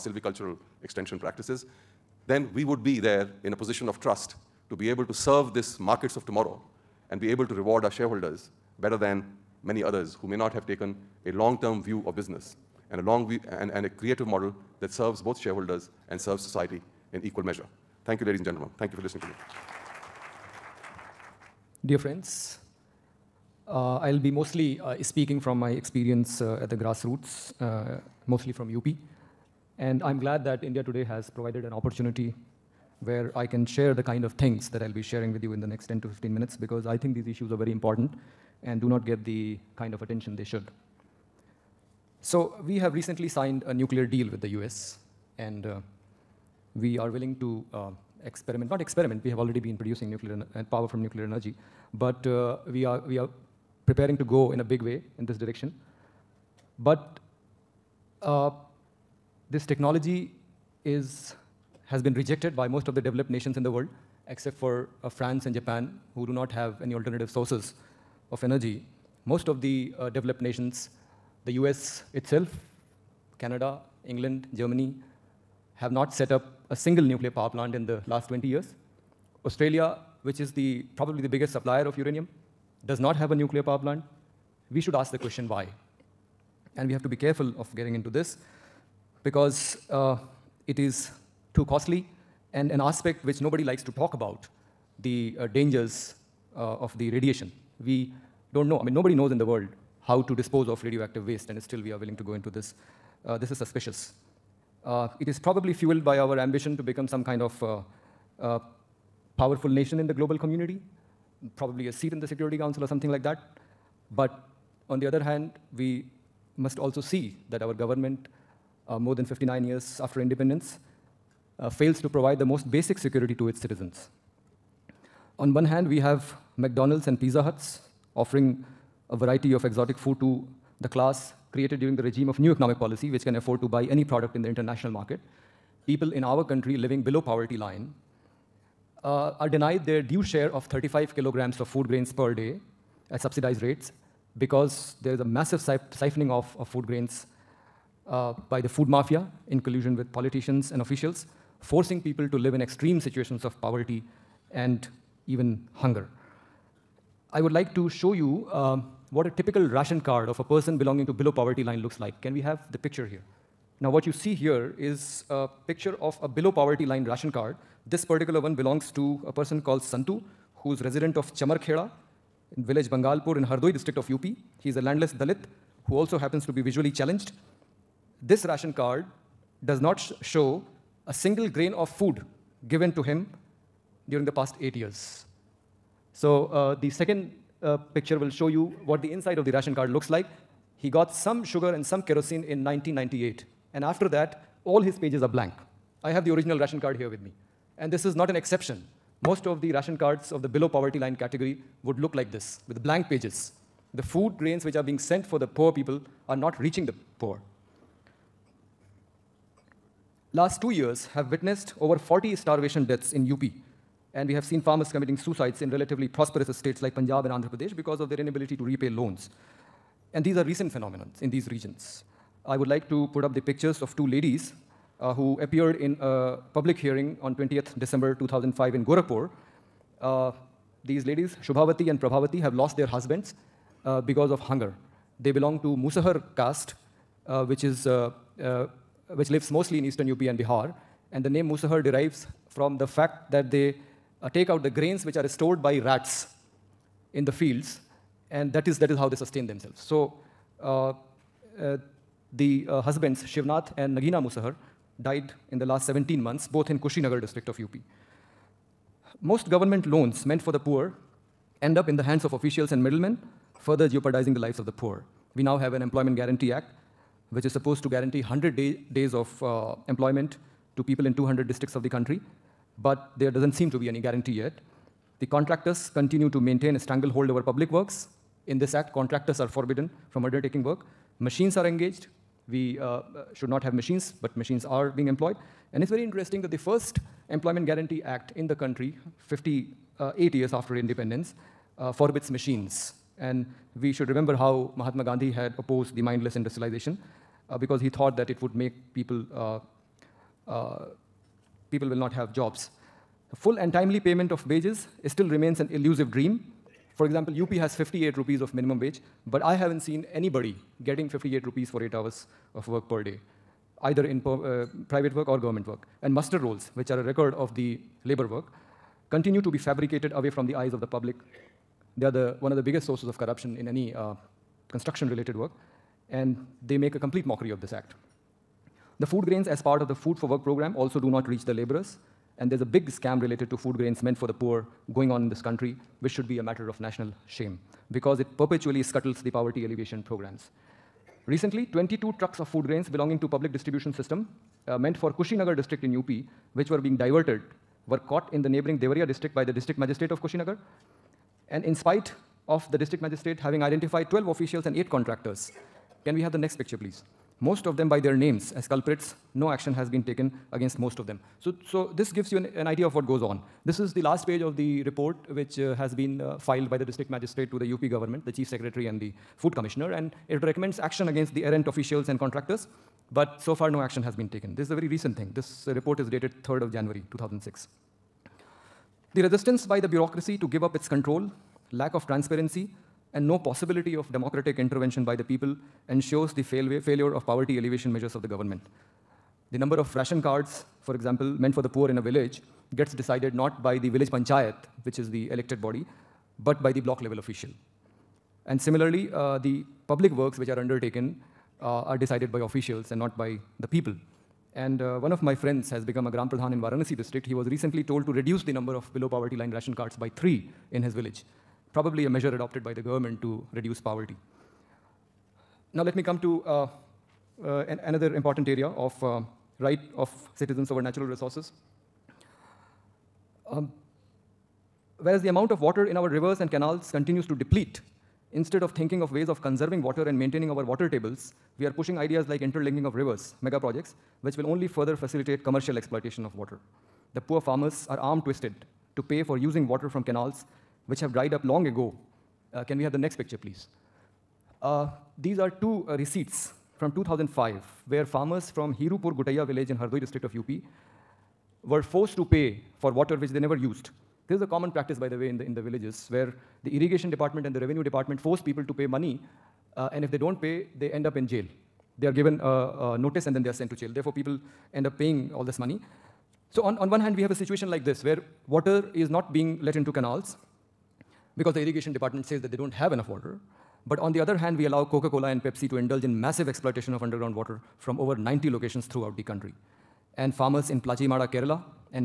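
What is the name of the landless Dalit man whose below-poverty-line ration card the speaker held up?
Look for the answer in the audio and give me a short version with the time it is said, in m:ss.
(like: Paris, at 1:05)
Santu, at 2:49.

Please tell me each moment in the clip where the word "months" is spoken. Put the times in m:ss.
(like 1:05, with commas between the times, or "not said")
4:16.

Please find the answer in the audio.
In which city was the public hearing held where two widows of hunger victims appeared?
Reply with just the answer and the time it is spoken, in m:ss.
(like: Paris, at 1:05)
Gorakhpur, at 3:48.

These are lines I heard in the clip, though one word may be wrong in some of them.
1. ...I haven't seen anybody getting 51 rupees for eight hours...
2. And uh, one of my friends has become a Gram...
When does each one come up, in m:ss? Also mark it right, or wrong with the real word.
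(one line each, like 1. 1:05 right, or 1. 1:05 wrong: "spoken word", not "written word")
1. 5:09 wrong: "58", not "51"
2. 6:44 right.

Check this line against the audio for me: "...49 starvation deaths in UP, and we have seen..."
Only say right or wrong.
wrong.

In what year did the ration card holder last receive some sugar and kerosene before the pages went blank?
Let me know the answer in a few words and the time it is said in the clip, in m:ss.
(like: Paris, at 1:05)
1998, at 3:12.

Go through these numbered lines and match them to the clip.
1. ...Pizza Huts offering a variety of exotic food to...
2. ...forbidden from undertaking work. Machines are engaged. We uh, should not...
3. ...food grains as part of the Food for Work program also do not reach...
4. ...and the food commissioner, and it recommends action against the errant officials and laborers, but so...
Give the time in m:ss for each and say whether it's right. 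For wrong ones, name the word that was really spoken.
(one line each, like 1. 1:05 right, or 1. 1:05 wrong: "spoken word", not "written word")
1. 2:07 right
2. 4:39 right
3. 5:29 right
4. 6:08 wrong: "contractors", not "laborers".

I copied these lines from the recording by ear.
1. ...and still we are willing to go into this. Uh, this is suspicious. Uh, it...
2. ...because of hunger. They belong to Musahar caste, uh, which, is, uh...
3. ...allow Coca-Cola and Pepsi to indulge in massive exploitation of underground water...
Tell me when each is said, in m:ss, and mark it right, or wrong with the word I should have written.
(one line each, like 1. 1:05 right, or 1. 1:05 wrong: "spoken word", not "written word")
1. 1:41 right
2. 3:54 right
3. 7:54 right.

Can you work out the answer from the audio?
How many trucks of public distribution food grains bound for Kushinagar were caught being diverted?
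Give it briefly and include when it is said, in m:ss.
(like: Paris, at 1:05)
22, at 5:41.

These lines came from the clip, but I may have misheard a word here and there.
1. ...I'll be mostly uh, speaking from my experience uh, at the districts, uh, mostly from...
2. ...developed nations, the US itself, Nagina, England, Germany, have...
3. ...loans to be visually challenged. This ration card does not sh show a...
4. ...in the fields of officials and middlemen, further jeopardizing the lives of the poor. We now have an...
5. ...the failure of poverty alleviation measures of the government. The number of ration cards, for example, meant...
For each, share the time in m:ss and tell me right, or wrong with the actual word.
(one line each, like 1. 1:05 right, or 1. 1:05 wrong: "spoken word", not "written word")
1. 0:23 wrong: "grassroots", not "districts"
2. 1:10 wrong: "Canada", not "Nagina"
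3. 2:56 wrong: "happens", not "loans"
4. 4:21 wrong: "hands", not "fields"
5. 6:26 right.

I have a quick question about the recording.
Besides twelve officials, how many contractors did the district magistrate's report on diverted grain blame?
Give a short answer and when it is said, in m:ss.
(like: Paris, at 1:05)
8, at 5:54.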